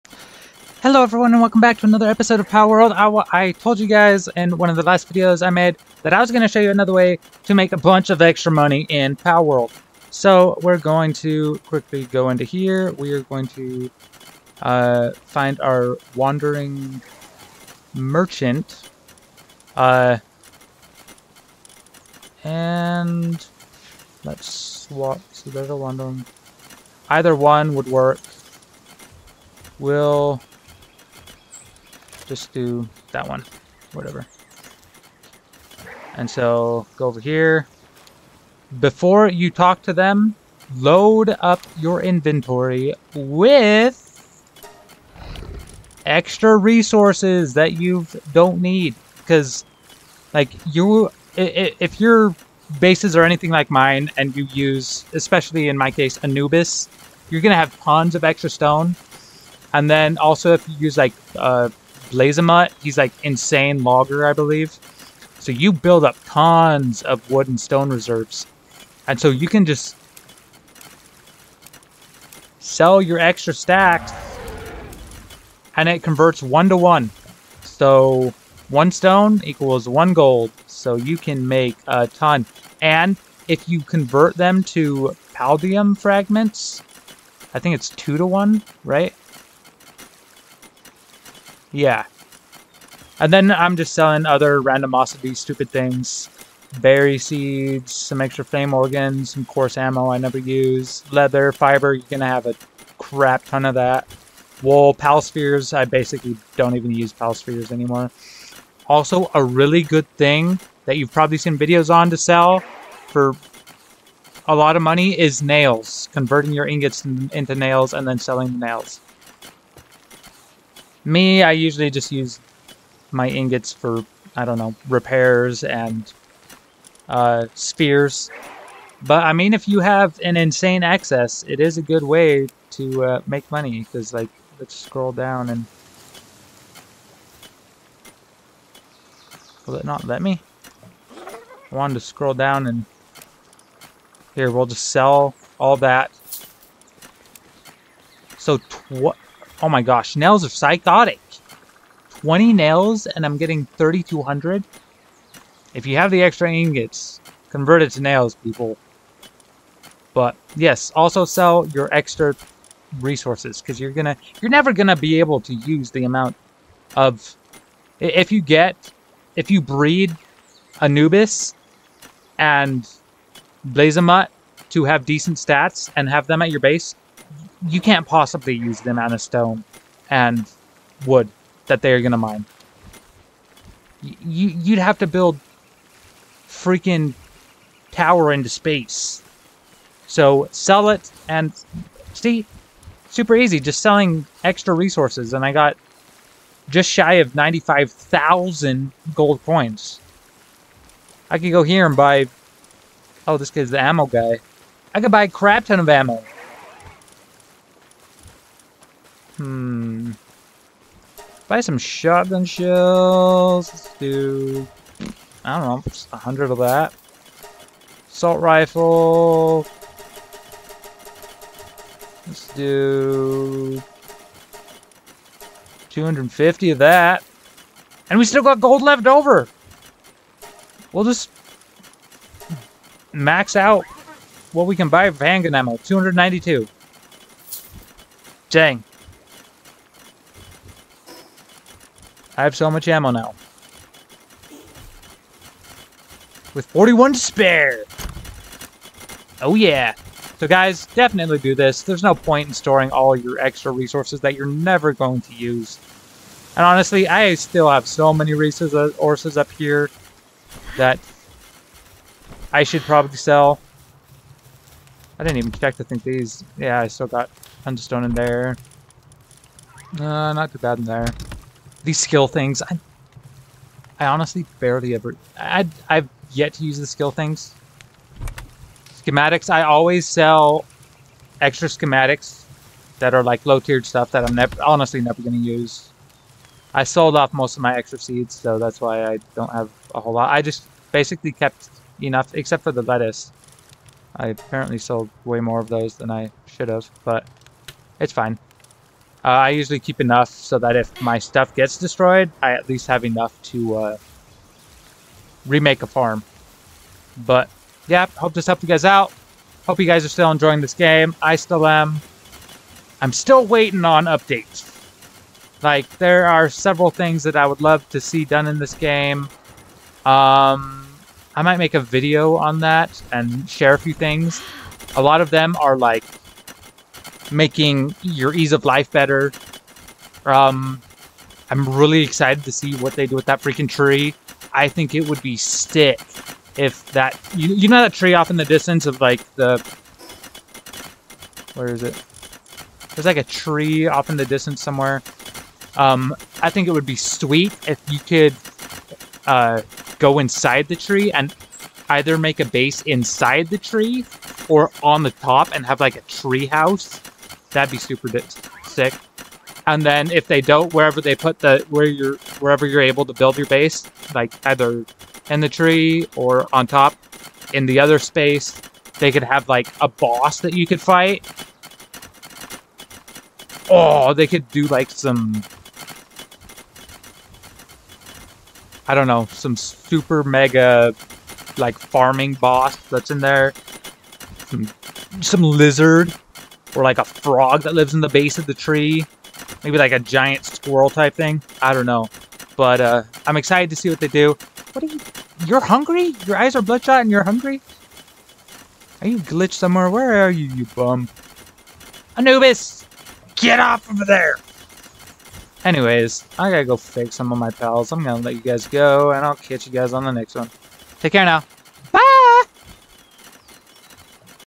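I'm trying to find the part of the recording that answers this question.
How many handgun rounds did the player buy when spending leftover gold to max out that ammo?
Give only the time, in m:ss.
3:55.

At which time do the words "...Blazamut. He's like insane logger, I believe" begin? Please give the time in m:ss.
1:02.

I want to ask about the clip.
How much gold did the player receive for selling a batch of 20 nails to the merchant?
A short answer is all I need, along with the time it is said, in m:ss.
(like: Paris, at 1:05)
3,200, at 2:33.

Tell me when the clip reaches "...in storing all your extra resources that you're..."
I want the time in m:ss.
4:12.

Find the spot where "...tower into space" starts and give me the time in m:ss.
3:07.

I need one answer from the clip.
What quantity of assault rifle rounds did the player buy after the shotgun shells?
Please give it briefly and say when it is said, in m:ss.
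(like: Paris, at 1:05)
250, at 3:45.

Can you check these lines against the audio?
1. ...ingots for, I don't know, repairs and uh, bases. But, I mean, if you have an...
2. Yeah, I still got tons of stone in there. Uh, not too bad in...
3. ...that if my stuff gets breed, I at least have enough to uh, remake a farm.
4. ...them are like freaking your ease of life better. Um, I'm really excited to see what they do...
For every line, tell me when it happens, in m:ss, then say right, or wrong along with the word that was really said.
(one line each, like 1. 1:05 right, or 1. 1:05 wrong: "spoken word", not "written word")
1. 2:03 wrong: "spheres", not "bases"
2. 4:26 right
3. 5:00 wrong: "destroyed", not "breed"
4. 5:25 wrong: "making", not "freaking".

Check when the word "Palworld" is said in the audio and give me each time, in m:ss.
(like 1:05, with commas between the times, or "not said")
0:02, 0:09.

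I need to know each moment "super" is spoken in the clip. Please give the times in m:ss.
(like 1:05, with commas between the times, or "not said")
3:13, 5:57, 6:19.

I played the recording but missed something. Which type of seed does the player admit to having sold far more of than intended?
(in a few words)
lettuce.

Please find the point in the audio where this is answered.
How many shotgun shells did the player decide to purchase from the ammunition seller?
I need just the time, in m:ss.
3:36.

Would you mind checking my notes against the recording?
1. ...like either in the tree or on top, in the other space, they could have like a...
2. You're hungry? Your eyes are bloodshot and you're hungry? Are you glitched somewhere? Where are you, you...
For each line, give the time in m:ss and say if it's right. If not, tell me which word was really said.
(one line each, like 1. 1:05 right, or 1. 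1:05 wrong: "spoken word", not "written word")
1. 6:04 right
2. 6:35 right.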